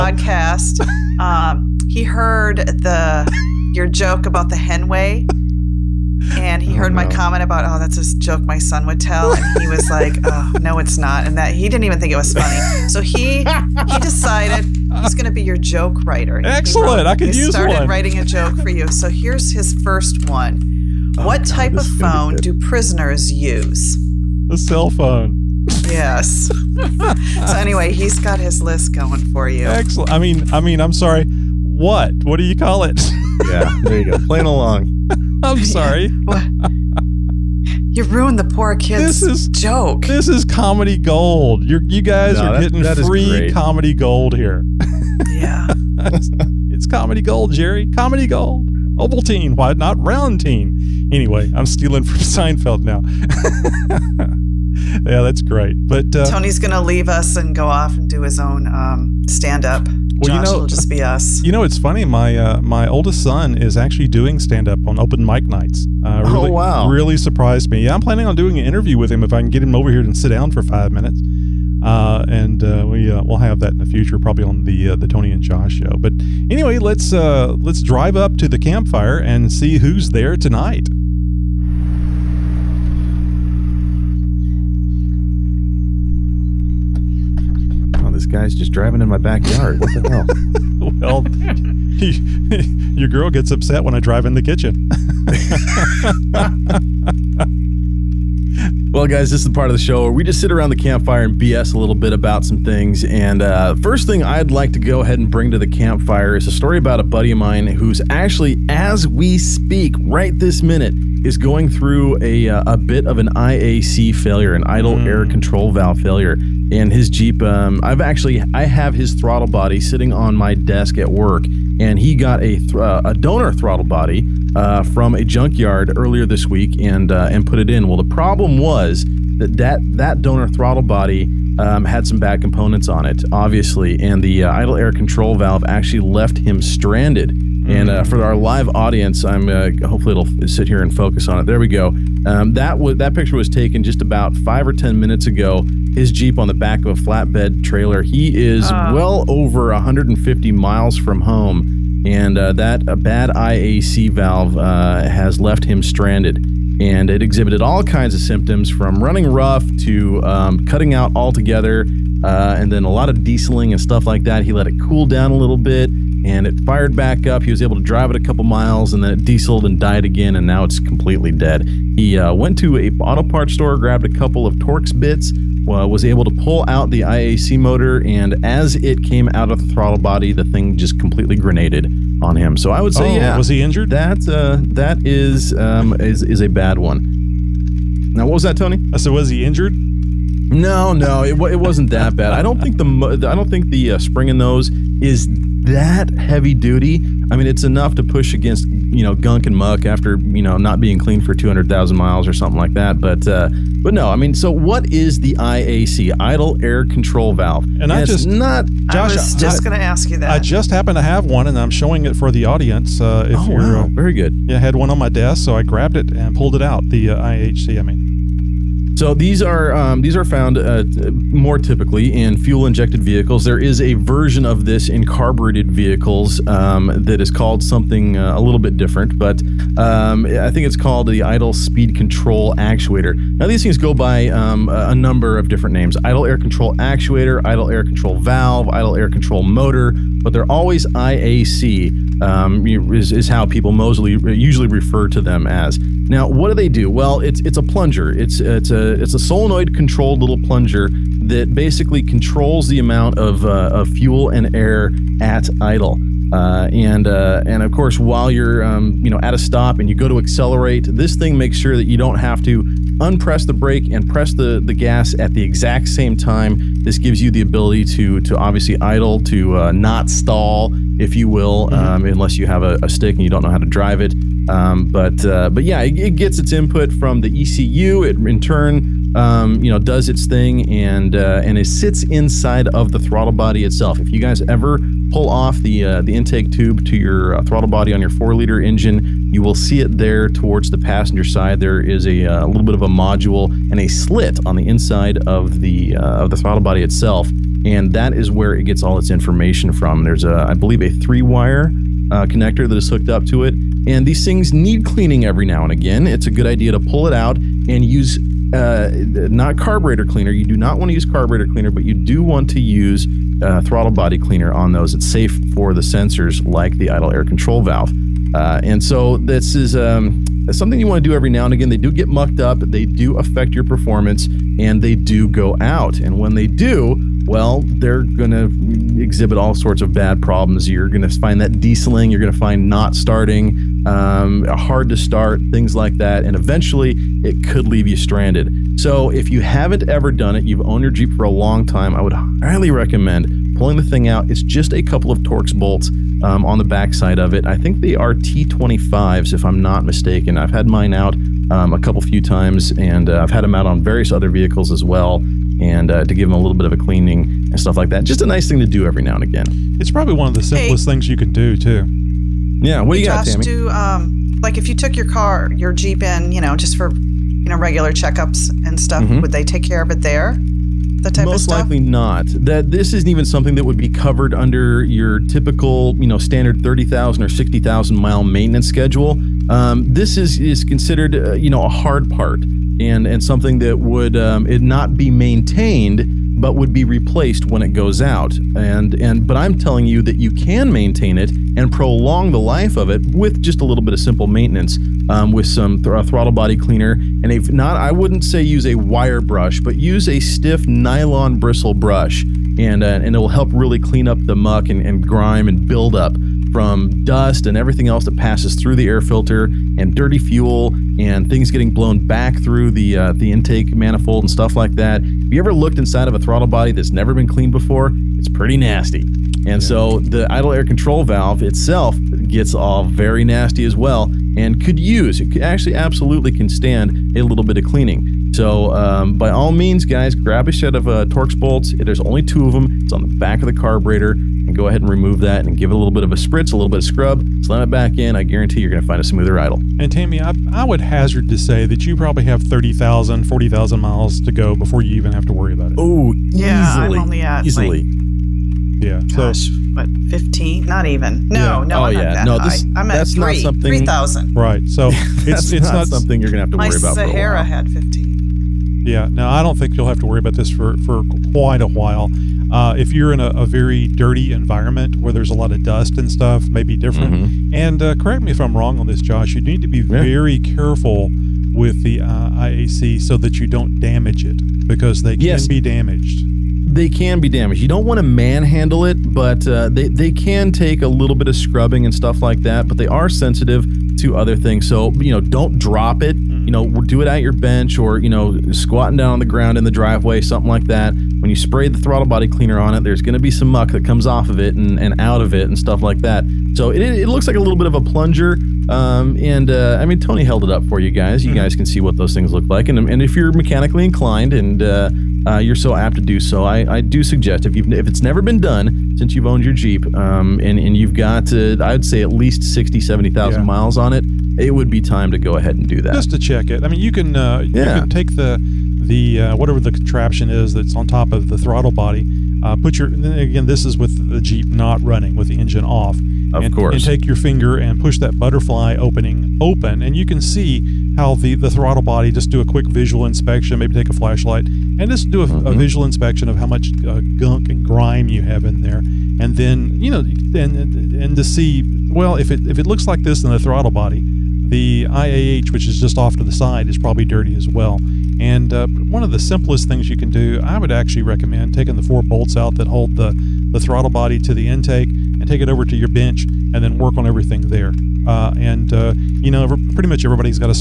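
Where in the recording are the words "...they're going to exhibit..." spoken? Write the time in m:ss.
5:27.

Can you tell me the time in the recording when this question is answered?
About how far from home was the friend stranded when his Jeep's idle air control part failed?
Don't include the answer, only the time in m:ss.
2:28.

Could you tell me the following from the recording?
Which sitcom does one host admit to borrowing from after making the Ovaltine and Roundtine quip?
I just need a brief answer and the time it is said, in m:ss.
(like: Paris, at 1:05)
Seinfeld, at 0:52.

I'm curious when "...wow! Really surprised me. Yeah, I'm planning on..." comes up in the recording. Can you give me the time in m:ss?
1:06.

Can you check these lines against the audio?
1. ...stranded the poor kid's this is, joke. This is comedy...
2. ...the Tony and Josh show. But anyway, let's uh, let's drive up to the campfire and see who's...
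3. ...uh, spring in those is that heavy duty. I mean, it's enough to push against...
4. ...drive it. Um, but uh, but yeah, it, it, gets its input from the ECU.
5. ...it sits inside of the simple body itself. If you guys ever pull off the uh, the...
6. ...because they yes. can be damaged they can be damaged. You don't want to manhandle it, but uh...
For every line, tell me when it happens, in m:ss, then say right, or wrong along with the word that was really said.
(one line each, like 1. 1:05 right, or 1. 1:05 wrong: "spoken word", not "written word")
1. 0:38 wrong: "ruined", not "stranded"
2. 1:14 right
3. 3:13 right
4. 4:33 right
5. 4:41 wrong: "throttle", not "simple"
6. 7:54 right.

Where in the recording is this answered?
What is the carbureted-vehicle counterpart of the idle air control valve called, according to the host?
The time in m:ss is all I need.
3:51.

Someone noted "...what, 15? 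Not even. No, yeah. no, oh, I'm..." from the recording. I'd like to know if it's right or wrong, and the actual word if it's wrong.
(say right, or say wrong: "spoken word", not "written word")
right.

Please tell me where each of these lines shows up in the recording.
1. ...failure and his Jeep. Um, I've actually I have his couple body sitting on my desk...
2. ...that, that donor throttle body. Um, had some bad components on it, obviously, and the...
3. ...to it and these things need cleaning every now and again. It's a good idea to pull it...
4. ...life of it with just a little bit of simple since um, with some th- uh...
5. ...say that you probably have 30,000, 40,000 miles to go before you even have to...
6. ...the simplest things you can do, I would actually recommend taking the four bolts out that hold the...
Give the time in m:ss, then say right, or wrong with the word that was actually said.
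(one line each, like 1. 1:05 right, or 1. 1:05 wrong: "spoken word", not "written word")
1. 1:56 wrong: "throttle", not "couple"
2. 2:09 right
3. 5:03 right
4. 6:32 wrong: "maintenance", not "since"
5. 7:21 right
6. 9:09 right.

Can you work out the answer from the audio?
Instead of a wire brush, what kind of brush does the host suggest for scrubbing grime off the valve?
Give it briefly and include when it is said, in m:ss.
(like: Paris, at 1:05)
Stiff nylon bristle brush, at 6:40.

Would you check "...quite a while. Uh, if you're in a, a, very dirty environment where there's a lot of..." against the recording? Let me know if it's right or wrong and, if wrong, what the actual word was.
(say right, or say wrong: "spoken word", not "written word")
right.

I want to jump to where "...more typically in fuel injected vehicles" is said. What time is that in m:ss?
3:41.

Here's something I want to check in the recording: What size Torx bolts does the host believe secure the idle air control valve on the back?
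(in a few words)
T25.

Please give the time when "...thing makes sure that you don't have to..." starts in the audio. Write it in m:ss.
4:21.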